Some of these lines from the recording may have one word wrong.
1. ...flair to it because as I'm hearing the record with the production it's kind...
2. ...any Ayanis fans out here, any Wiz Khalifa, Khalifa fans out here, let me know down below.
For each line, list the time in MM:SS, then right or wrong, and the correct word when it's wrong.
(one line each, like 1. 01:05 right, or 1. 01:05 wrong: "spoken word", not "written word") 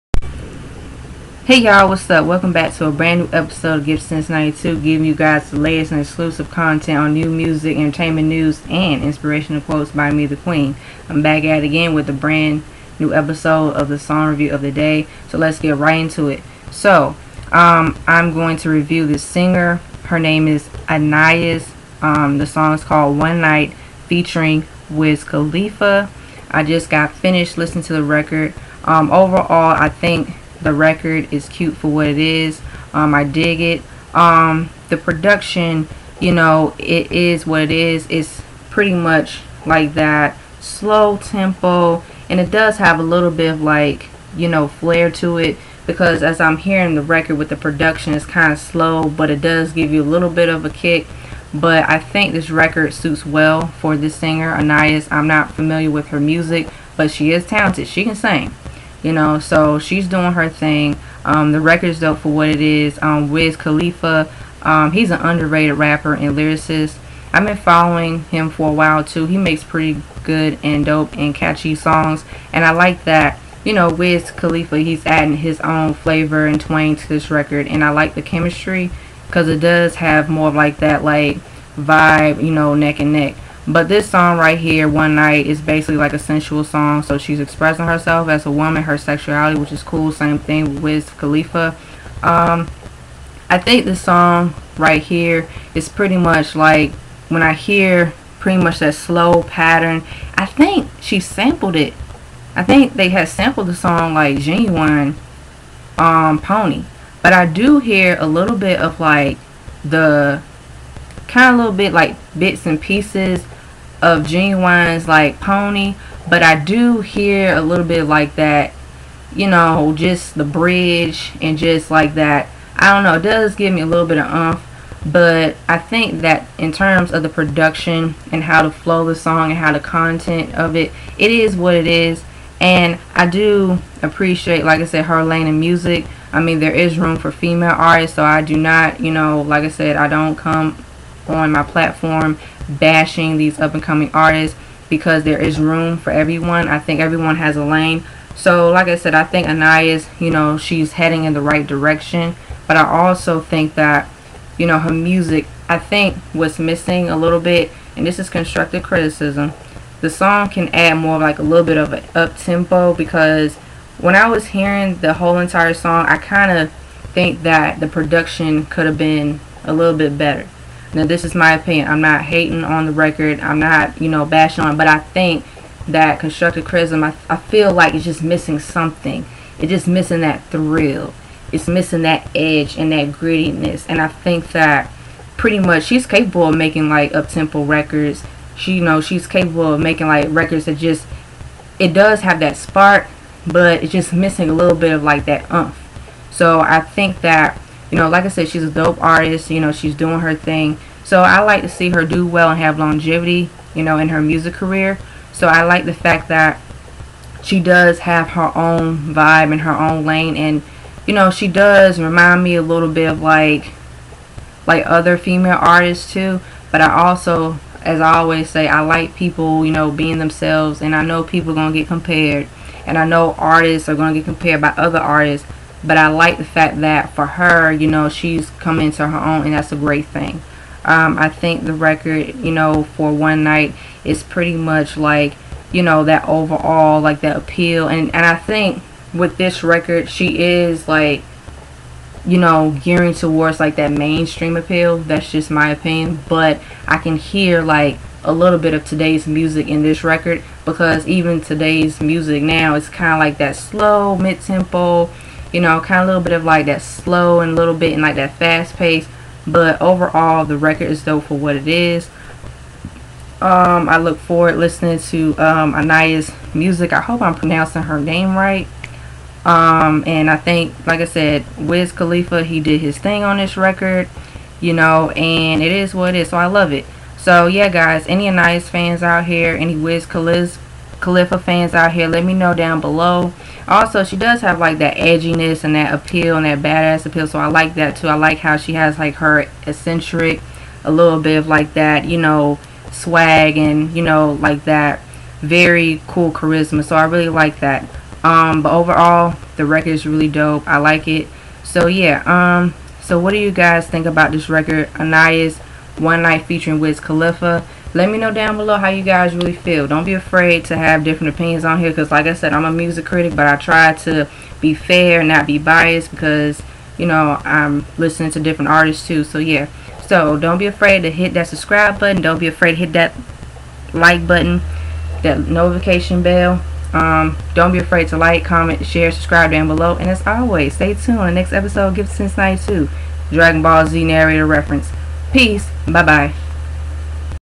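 1. 00:44 right
2. 04:38 right.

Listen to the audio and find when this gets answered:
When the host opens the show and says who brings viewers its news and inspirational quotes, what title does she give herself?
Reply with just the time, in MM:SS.
00:10.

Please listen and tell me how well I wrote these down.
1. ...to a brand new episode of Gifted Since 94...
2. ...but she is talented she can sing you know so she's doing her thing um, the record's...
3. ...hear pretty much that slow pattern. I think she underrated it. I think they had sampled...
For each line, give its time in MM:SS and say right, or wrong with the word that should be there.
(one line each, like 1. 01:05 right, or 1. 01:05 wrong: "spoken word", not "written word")
1. 00:02 wrong: "92", not "94"
2. 00:56 right
3. 01:37 wrong: "sampled", not "underrated".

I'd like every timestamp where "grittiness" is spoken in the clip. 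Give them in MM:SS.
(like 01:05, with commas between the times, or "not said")
03:03.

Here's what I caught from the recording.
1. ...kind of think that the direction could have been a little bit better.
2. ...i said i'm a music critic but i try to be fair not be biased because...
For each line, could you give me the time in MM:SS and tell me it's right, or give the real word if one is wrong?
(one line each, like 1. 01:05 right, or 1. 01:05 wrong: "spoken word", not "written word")
1. 02:46 wrong: "production", not "direction"
2. 05:12 right.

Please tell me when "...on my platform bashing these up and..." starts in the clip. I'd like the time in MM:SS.
02:21.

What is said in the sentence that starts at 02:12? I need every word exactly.
And I do appreciate, like I said, her lane in music.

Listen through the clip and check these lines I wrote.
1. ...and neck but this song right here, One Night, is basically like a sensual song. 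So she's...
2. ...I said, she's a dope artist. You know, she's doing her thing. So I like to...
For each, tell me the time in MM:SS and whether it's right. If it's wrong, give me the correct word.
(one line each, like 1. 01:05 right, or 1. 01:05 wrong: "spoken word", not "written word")
1. 01:22 right
2. 03:18 right.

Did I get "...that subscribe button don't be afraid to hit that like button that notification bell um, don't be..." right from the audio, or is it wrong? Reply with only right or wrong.
right.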